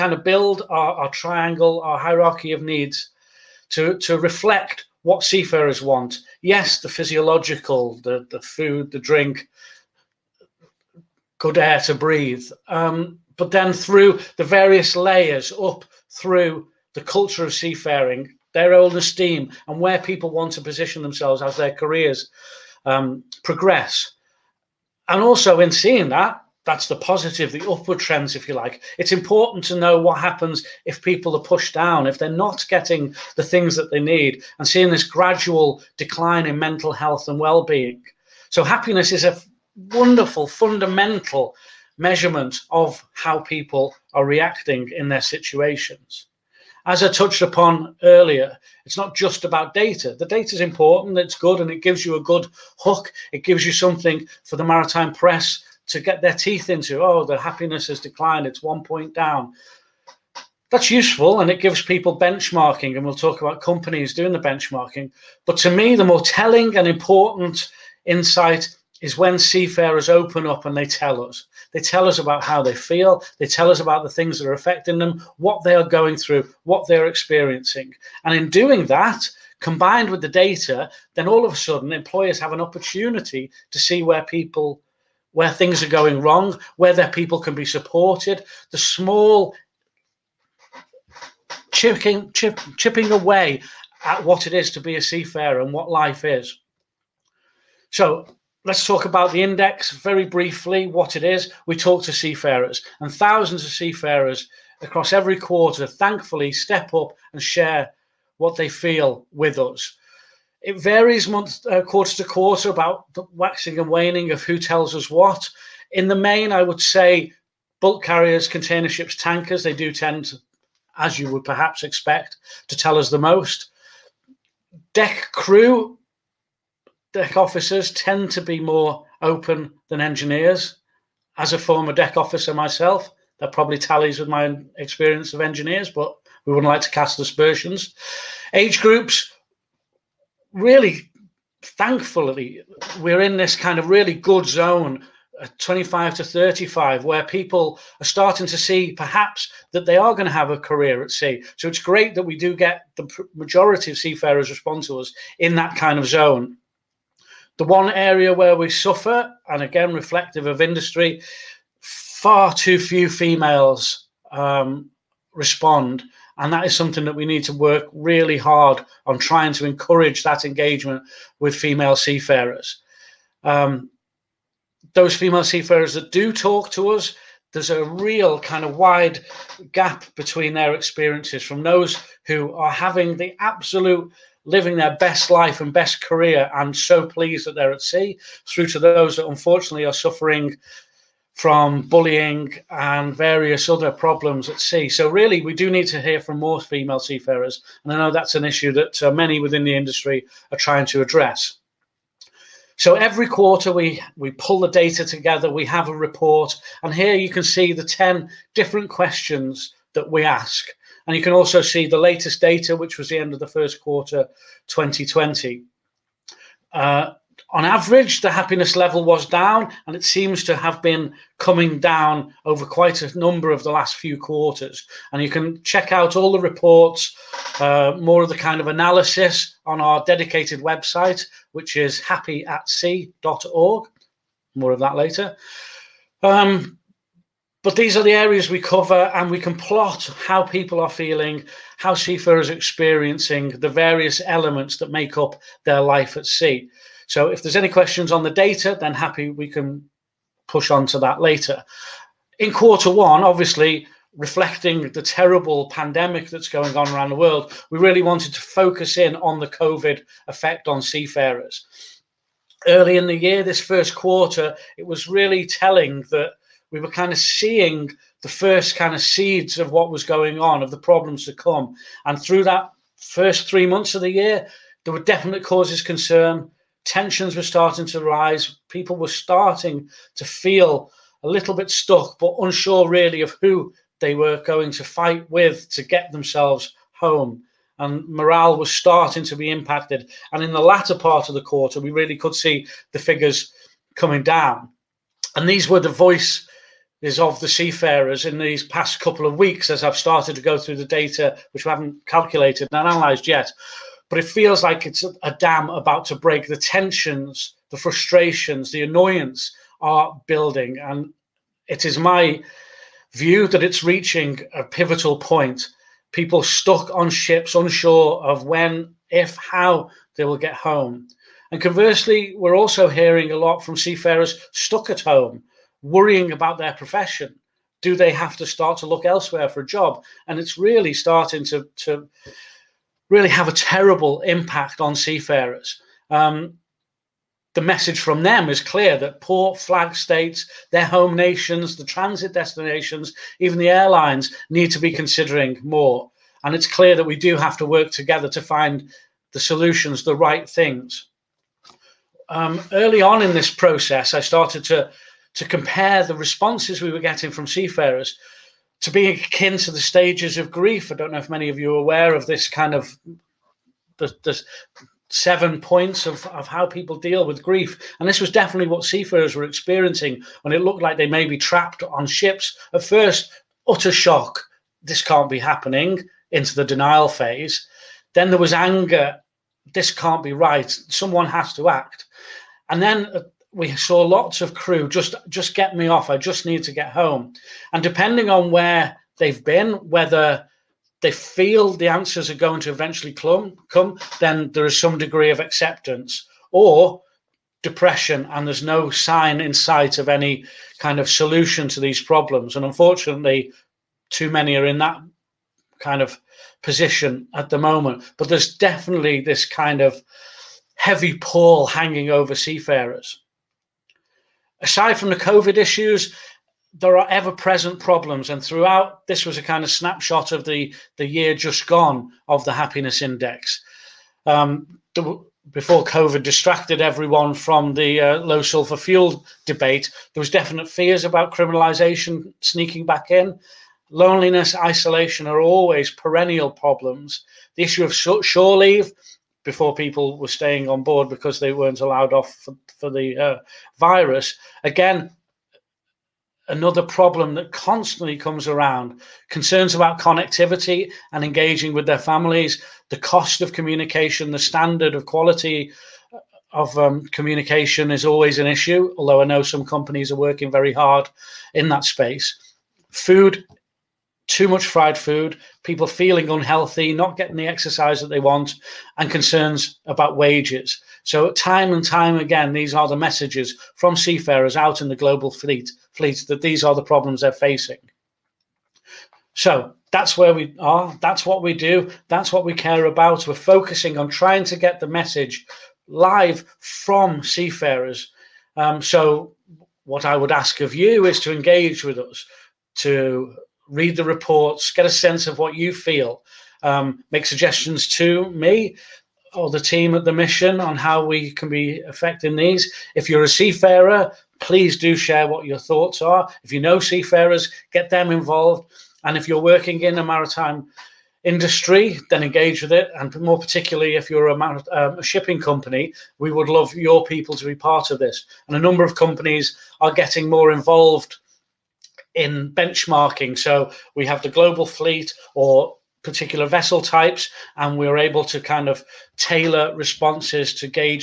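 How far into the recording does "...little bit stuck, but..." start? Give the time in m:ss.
4:41.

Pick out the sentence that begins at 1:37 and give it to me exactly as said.
So Let's talk about the index very briefly, what it is.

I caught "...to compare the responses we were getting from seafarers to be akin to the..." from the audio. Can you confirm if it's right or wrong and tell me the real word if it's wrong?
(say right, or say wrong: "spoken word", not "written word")
right.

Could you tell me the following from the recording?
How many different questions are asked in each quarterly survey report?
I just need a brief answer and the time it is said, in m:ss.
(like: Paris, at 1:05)
10, at 3:27.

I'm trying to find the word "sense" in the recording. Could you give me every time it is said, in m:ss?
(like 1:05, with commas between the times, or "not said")
8:14.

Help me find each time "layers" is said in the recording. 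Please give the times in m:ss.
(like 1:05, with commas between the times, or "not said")
0:14.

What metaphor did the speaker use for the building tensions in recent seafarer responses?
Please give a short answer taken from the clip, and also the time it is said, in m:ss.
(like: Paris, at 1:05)
A dam about to break, at 5:05.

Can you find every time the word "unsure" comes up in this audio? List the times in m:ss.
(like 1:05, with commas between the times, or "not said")
4:42, 5:17.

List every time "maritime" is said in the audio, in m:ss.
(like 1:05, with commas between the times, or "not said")
0:54, 8:30.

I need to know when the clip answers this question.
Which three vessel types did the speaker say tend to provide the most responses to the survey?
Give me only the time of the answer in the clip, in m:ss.
1:57.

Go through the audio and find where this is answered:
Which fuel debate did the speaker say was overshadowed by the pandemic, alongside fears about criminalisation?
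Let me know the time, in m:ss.
7:08.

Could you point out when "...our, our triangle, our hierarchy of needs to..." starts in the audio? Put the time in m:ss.
0:00.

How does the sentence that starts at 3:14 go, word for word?
So, really, we do need to hear from more female seafarers.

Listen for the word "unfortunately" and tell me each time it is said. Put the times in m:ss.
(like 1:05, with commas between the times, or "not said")
3:09, 6:42.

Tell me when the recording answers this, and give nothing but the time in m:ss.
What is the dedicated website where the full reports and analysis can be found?
3:51.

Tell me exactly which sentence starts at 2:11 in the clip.
As a former deck officer myself, that probably tallies with my experience of engineers, but we wouldn't like to cast aspersions.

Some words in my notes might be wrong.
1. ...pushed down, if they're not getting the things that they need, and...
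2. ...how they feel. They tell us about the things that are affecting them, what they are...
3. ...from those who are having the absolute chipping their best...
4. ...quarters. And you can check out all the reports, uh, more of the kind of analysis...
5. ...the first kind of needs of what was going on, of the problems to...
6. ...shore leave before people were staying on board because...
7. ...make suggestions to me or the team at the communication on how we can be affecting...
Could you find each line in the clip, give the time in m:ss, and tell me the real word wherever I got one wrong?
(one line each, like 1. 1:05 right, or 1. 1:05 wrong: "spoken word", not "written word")
1. 0:31 right
2. 1:12 right
3. 3:01 wrong: "living", not "chipping"
4. 3:44 right
5. 4:28 wrong: "seeds", not "needs"
6. 7:17 right
7. 8:17 wrong: "mission", not "communication".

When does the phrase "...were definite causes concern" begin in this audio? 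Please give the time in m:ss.
4:34.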